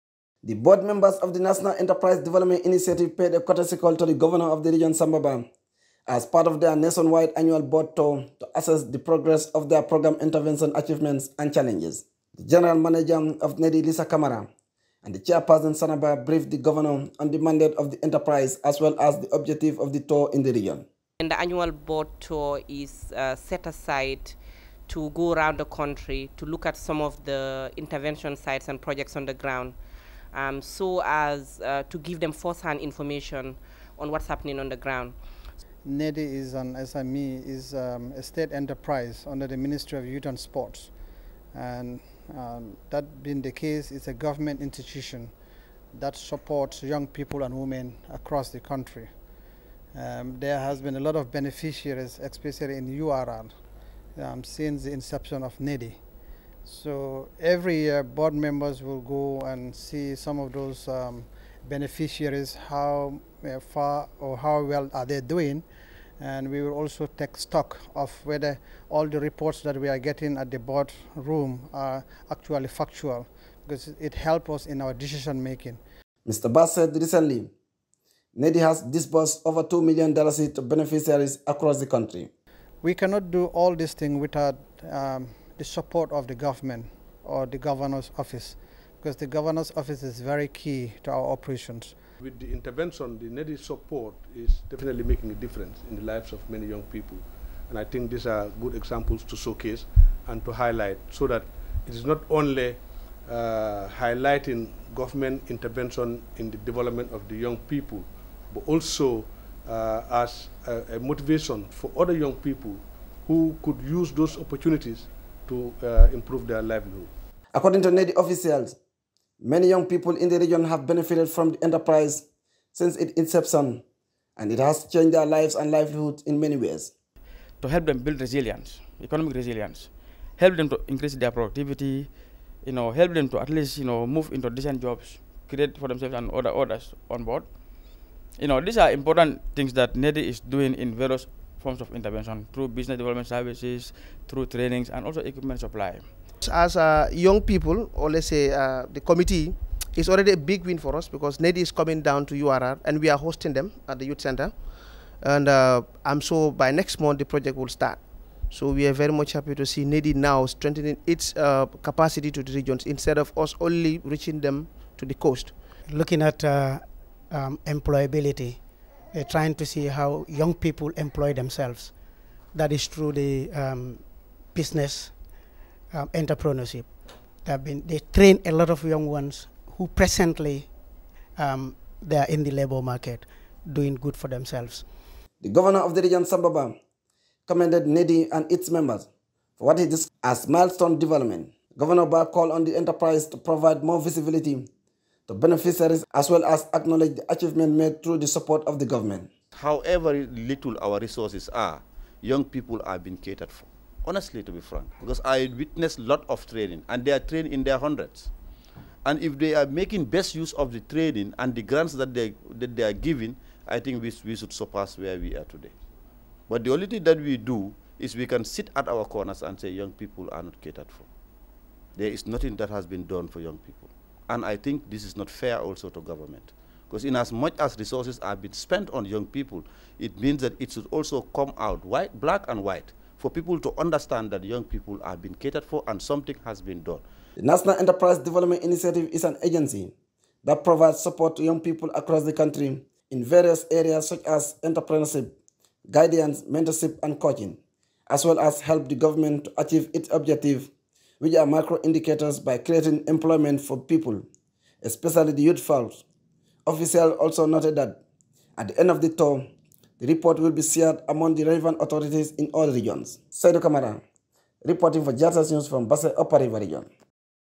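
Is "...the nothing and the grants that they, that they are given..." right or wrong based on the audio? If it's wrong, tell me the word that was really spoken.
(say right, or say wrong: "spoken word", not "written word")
wrong: "training", not "nothing".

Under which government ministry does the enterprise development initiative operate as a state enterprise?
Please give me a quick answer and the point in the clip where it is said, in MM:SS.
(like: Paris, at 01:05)
Ministry of Youth and Sports, at 00:39.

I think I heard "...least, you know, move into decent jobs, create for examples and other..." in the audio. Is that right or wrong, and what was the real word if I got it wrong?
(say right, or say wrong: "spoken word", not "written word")
wrong: "themselves", not "examples".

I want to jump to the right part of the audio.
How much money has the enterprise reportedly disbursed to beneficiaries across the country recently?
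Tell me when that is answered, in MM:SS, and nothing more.
01:19.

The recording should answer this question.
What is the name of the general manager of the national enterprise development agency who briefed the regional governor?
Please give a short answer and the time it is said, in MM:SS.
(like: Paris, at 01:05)
Lisa Kamara, at 00:13.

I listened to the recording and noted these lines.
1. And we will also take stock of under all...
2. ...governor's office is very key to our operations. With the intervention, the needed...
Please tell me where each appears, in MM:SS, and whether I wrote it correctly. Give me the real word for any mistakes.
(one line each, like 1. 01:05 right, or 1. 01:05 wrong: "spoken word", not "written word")
1. 01:06 wrong: "whether", not "under"
2. 01:29 right.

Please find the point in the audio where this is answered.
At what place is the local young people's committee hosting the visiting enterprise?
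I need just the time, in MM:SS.
02:34.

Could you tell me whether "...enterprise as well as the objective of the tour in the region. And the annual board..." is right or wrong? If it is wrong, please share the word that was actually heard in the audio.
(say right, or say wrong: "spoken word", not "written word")
right.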